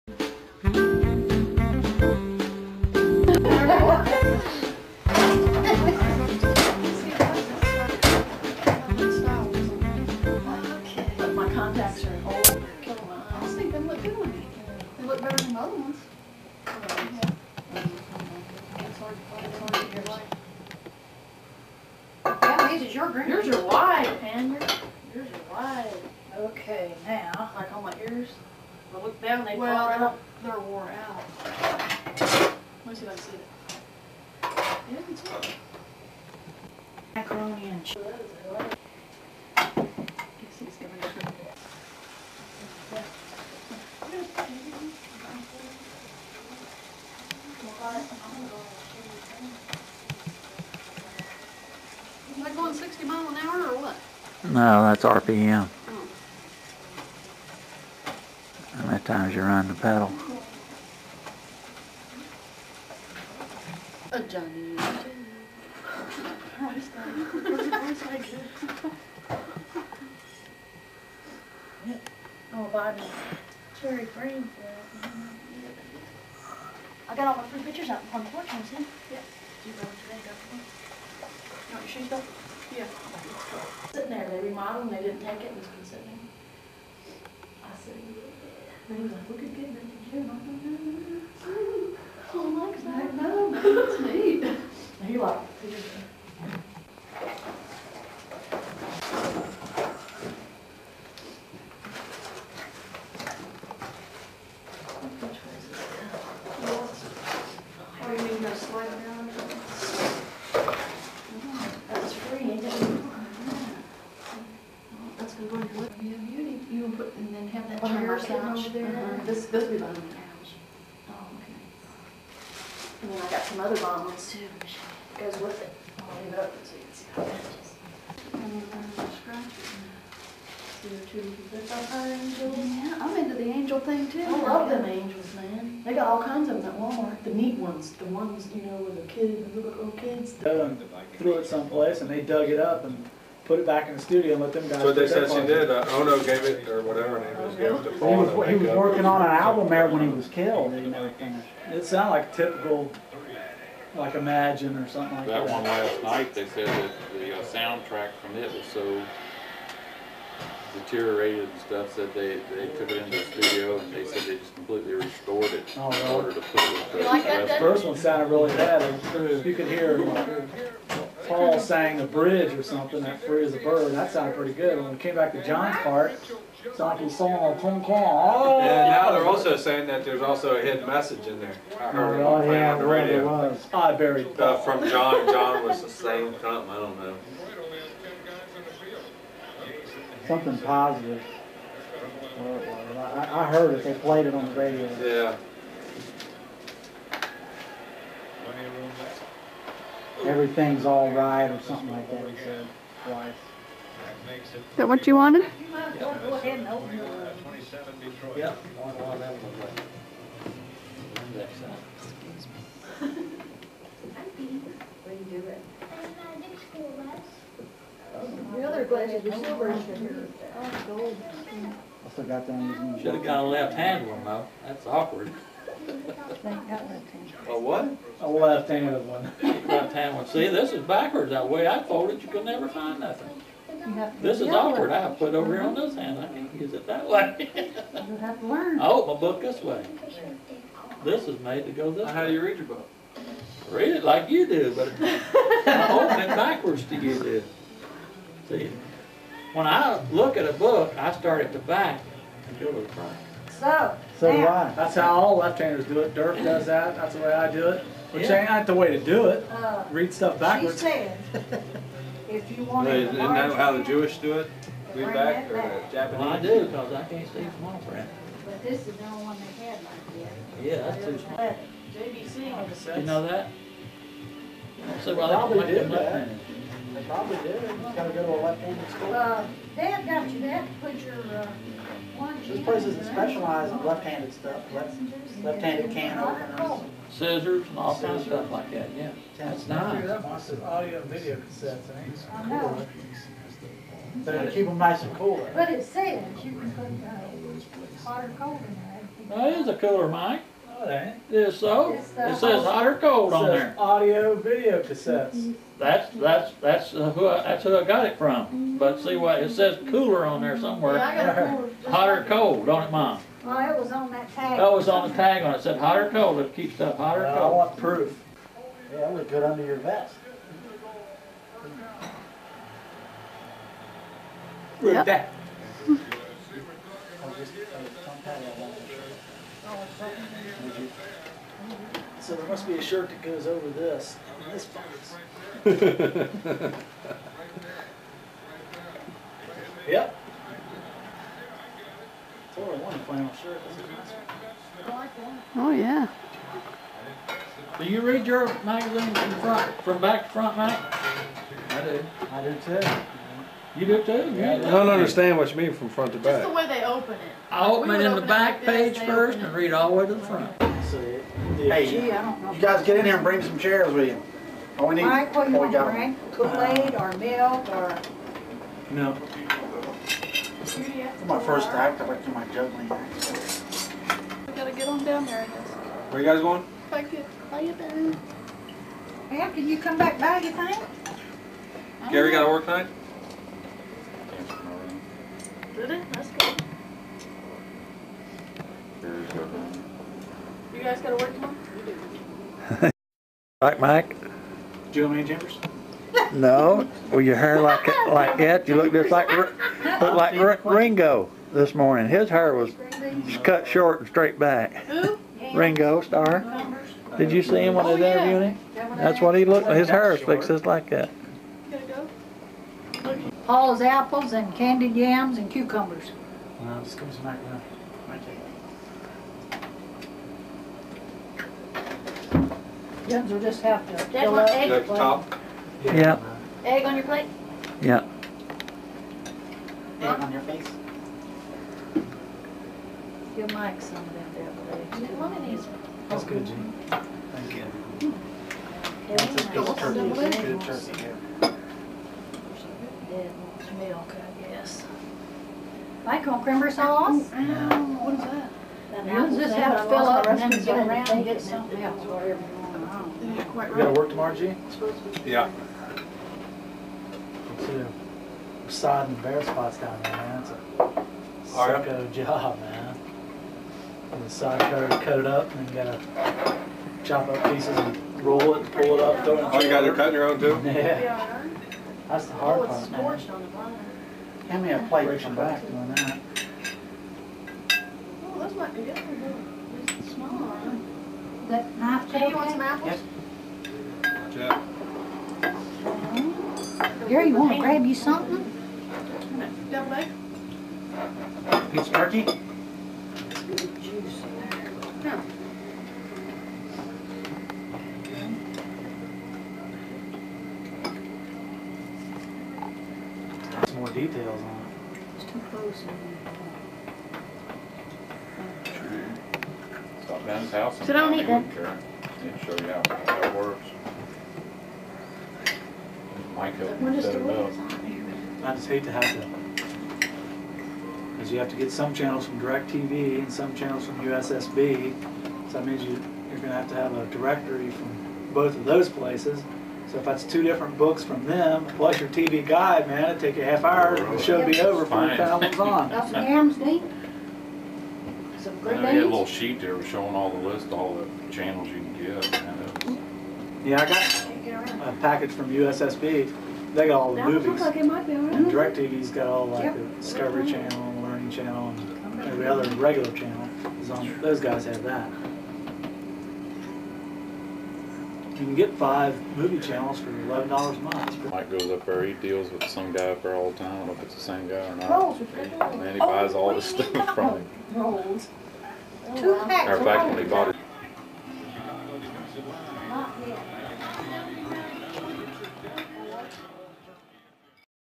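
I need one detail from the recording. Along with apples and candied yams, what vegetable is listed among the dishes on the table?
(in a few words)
Cucumbers.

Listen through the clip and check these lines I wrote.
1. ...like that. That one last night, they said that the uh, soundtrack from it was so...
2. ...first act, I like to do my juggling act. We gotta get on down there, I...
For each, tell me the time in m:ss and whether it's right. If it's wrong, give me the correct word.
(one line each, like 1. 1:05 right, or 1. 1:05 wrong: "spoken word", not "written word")
1. 2:35 right
2. 6:11 right.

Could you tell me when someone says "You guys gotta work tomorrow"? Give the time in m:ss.
6:30.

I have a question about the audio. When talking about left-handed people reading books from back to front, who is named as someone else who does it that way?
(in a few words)
Dirk.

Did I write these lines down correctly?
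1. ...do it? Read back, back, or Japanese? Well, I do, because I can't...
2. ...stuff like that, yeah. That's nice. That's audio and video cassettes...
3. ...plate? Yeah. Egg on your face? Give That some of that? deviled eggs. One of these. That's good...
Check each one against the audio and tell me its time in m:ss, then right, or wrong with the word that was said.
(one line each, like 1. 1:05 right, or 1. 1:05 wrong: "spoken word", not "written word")
1. 4:24 right
2. 4:48 right
3. 7:07 wrong: "Mike", not "That".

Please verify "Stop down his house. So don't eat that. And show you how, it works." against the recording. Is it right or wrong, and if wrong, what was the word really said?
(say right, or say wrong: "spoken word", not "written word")
right.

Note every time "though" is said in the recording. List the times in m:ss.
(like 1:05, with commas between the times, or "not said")
1:22, 3:44.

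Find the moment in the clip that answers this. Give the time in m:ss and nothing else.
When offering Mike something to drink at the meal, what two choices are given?
6:06.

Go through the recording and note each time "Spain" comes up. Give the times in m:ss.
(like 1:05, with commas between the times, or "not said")
not said.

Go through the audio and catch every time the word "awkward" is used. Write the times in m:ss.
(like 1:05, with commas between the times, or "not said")
3:44, 3:54.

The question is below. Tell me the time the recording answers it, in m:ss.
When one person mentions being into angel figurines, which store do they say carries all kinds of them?
2:16.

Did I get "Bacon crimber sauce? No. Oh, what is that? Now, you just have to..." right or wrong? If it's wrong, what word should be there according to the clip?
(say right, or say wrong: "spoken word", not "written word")
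right.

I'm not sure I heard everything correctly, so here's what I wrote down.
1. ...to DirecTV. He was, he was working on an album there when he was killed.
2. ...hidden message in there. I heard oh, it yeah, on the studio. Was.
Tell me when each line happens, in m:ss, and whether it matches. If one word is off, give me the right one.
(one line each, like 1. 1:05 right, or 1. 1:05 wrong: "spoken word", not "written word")
1. 2:27 wrong: "Paul", not "DirecTV"
2. 3:00 wrong: "radio", not "studio".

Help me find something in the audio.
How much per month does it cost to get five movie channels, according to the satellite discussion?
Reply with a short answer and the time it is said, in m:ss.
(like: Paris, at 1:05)
$11, at 9:20.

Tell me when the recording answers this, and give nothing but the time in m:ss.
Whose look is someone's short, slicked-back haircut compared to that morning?
6:45.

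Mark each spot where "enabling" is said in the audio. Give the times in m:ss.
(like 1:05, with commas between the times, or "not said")
not said.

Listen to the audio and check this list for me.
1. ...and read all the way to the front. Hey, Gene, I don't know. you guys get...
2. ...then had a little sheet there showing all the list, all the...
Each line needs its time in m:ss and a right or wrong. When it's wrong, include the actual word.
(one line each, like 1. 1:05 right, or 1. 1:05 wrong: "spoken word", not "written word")
1. 5:59 wrong: "Gee", not "Gene"
2. 8:58 right.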